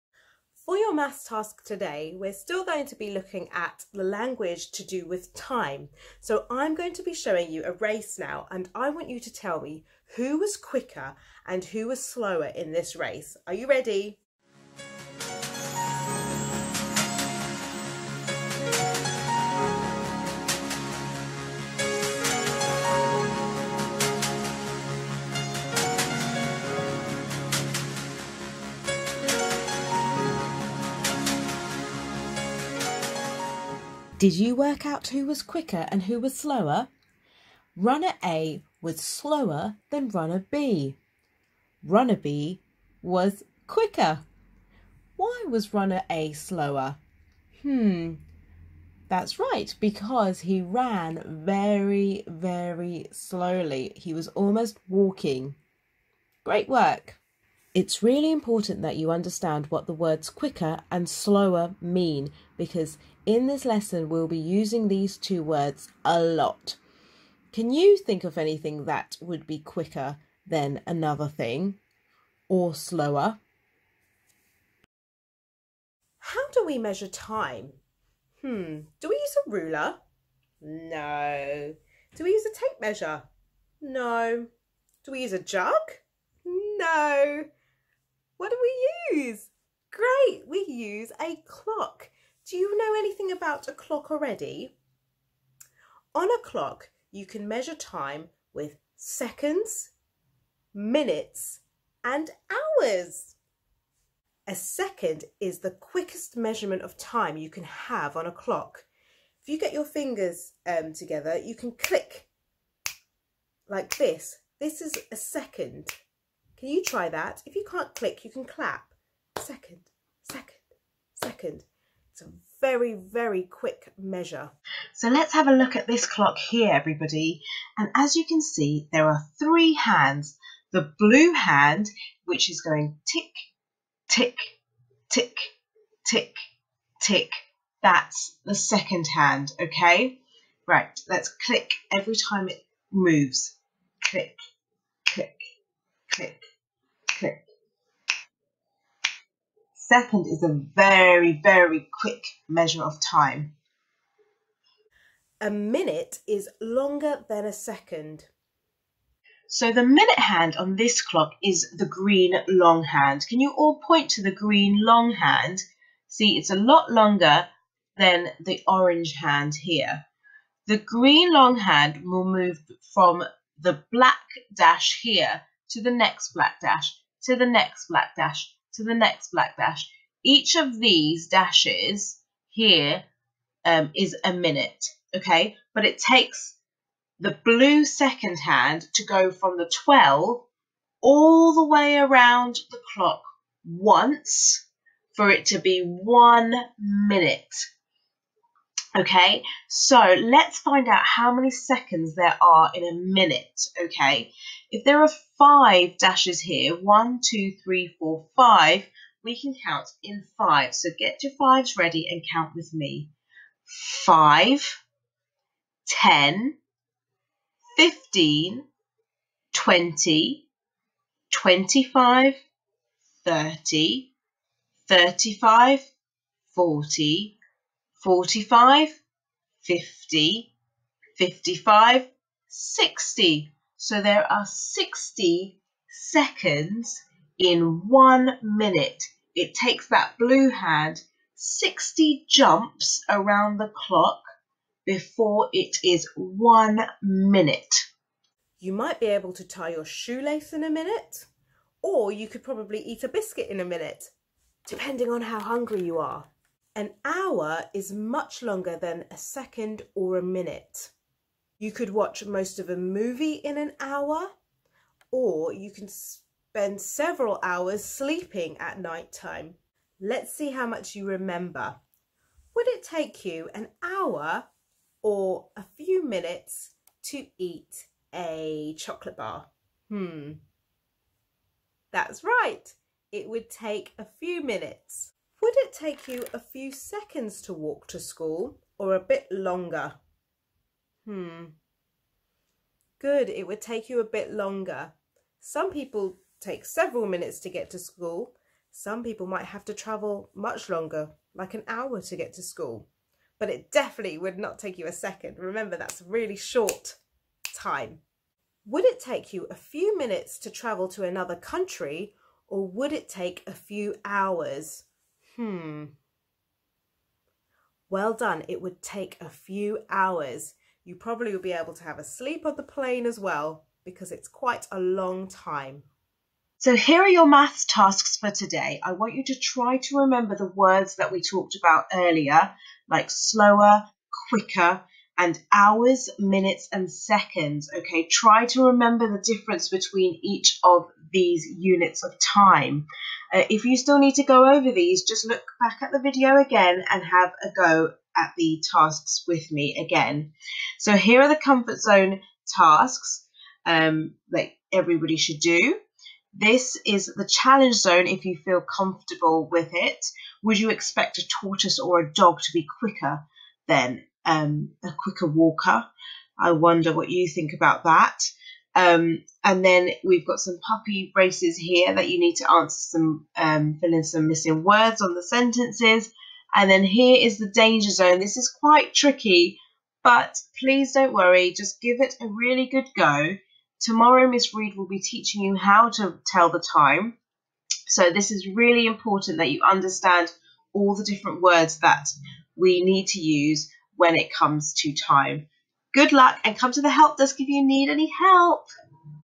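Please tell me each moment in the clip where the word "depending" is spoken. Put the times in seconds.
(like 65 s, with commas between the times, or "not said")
254 s.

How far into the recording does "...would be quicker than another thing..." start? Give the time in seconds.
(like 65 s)
69 s.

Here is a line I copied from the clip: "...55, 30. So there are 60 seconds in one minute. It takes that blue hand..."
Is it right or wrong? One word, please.
wrong.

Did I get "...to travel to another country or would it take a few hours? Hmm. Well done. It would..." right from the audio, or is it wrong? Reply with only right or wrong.
right.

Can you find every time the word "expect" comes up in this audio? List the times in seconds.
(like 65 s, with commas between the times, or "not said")
360 s.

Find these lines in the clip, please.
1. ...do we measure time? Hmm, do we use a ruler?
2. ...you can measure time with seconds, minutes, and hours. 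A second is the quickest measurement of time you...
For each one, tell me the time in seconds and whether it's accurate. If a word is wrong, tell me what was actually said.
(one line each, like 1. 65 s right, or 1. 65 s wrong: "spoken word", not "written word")
1. 76 s right
2. 97 s right.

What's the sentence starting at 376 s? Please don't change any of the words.
And then here is the danger zone.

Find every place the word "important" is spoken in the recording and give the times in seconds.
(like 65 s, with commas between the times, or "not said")
58 s, 388 s.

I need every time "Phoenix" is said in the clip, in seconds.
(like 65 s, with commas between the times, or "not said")
not said.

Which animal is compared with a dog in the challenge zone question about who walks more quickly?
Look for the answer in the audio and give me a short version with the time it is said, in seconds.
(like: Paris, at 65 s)
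Tortoise, at 361 s.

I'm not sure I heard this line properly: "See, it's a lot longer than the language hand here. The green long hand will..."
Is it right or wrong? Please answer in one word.
wrong.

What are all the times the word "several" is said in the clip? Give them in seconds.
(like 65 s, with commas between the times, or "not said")
266 s, 296 s.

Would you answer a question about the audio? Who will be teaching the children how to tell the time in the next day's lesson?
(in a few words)
Miss Reed.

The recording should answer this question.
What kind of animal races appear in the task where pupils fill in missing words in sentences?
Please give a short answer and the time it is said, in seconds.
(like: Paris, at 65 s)
Puppy, at 370 s.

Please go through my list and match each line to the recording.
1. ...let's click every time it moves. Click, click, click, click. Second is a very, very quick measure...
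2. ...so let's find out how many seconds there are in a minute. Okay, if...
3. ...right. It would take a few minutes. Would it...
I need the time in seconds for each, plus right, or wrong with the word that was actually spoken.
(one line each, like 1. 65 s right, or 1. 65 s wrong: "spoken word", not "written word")
1. 141 s right
2. 199 s right
3. 282 s right.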